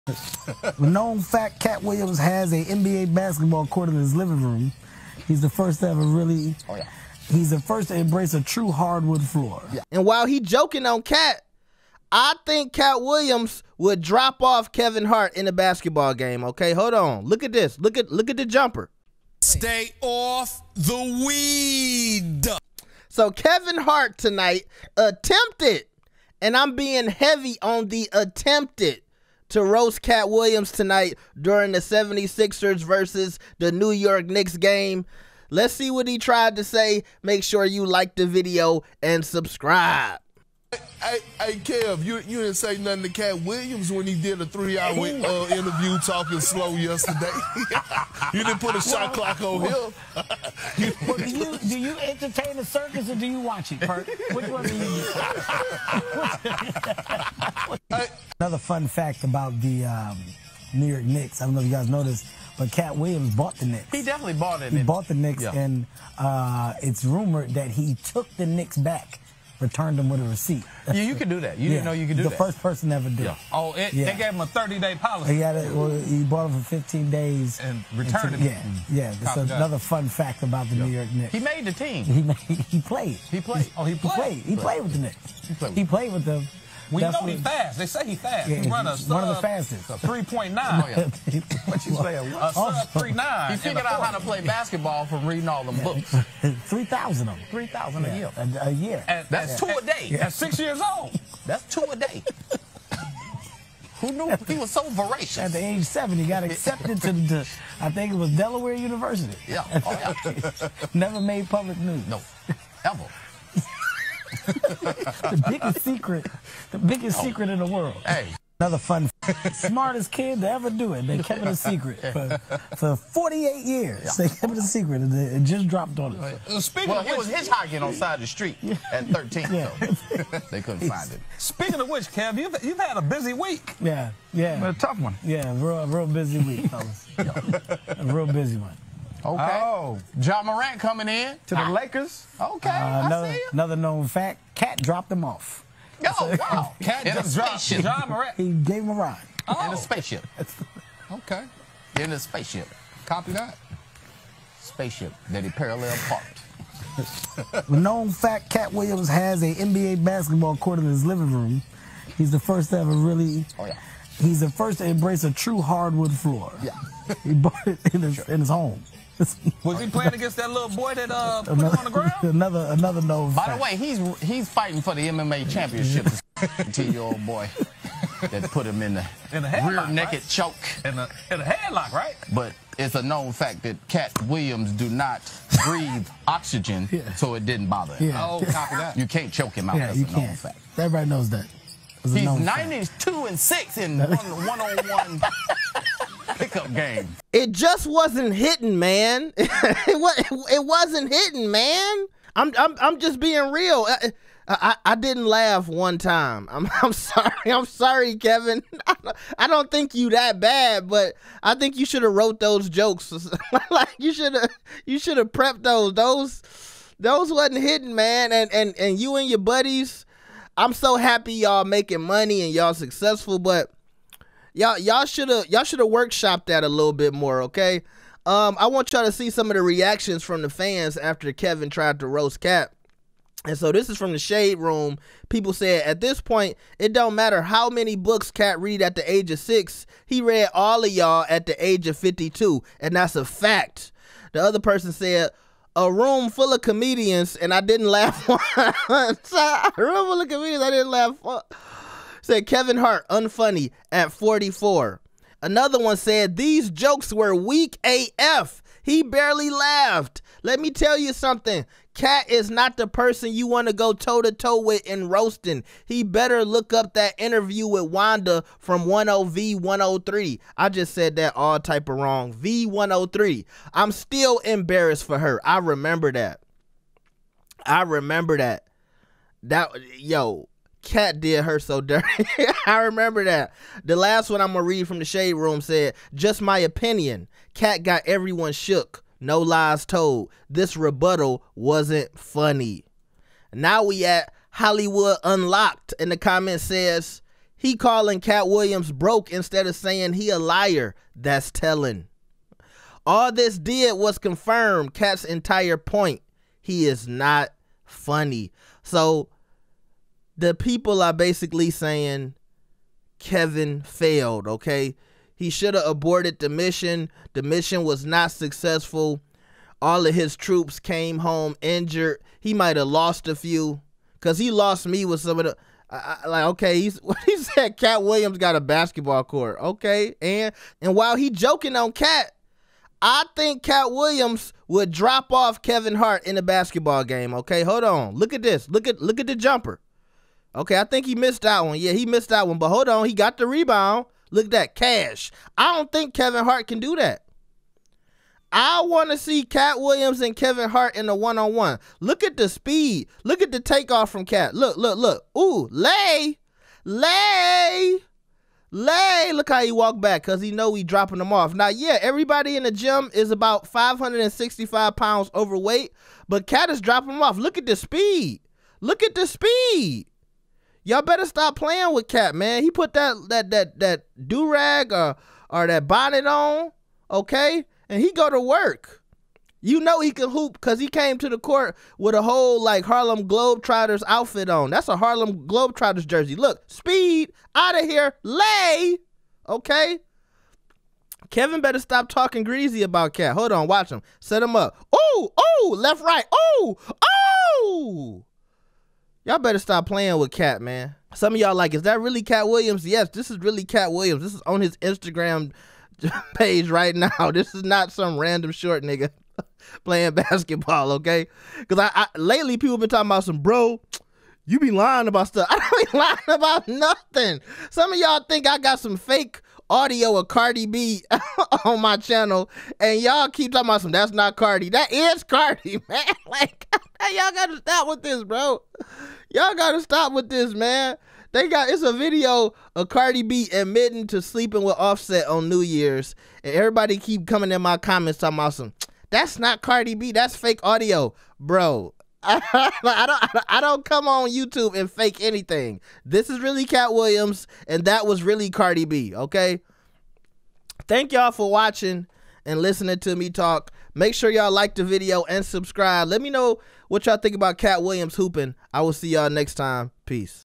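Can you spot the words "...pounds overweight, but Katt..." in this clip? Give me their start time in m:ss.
6:04.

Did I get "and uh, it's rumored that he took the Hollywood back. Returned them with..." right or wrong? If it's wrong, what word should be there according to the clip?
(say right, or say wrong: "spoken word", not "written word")
wrong: "Knicks", not "Hollywood".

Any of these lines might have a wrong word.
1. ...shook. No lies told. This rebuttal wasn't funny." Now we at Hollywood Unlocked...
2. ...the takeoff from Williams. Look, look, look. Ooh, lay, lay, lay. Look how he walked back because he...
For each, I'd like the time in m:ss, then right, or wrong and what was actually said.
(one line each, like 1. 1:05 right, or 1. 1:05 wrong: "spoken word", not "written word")
1. 4:48 right
2. 5:53 wrong: "Katt", not "Williams".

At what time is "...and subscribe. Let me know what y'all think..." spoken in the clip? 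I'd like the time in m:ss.
7:35.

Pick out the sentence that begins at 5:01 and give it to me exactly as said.
That's telling." All this did was confirm Katt's entire point.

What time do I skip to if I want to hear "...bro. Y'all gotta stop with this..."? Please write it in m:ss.
7:08.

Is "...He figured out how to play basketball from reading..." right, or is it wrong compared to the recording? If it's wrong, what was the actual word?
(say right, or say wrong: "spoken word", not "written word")
right.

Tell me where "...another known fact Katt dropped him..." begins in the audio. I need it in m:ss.
2:23.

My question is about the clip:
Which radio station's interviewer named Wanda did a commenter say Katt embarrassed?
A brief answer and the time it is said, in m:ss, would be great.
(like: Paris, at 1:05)
V103, at 4:32.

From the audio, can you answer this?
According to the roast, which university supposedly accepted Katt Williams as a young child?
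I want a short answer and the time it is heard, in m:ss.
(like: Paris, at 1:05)
Delaware University, at 1:48.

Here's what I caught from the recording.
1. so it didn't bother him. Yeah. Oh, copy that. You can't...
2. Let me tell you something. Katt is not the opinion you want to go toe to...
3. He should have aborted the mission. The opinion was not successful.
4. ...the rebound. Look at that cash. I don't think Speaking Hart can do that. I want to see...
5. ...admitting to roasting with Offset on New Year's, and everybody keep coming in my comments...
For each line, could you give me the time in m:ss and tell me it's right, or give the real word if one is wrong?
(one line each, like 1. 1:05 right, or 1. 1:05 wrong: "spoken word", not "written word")
1. 3:07 right
2. 4:20 wrong: "person", not "opinion"
3. 5:15 wrong: "mission", not "opinion"
4. 5:43 wrong: "Kevin", not "Speaking"
5. 7:13 wrong: "sleeping", not "roasting".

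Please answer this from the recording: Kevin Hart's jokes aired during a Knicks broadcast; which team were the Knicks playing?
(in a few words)
76ers.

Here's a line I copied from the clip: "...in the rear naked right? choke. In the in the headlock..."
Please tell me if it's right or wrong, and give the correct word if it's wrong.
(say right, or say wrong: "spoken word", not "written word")
right.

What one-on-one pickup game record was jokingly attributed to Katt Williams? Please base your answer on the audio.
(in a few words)
92 and 6.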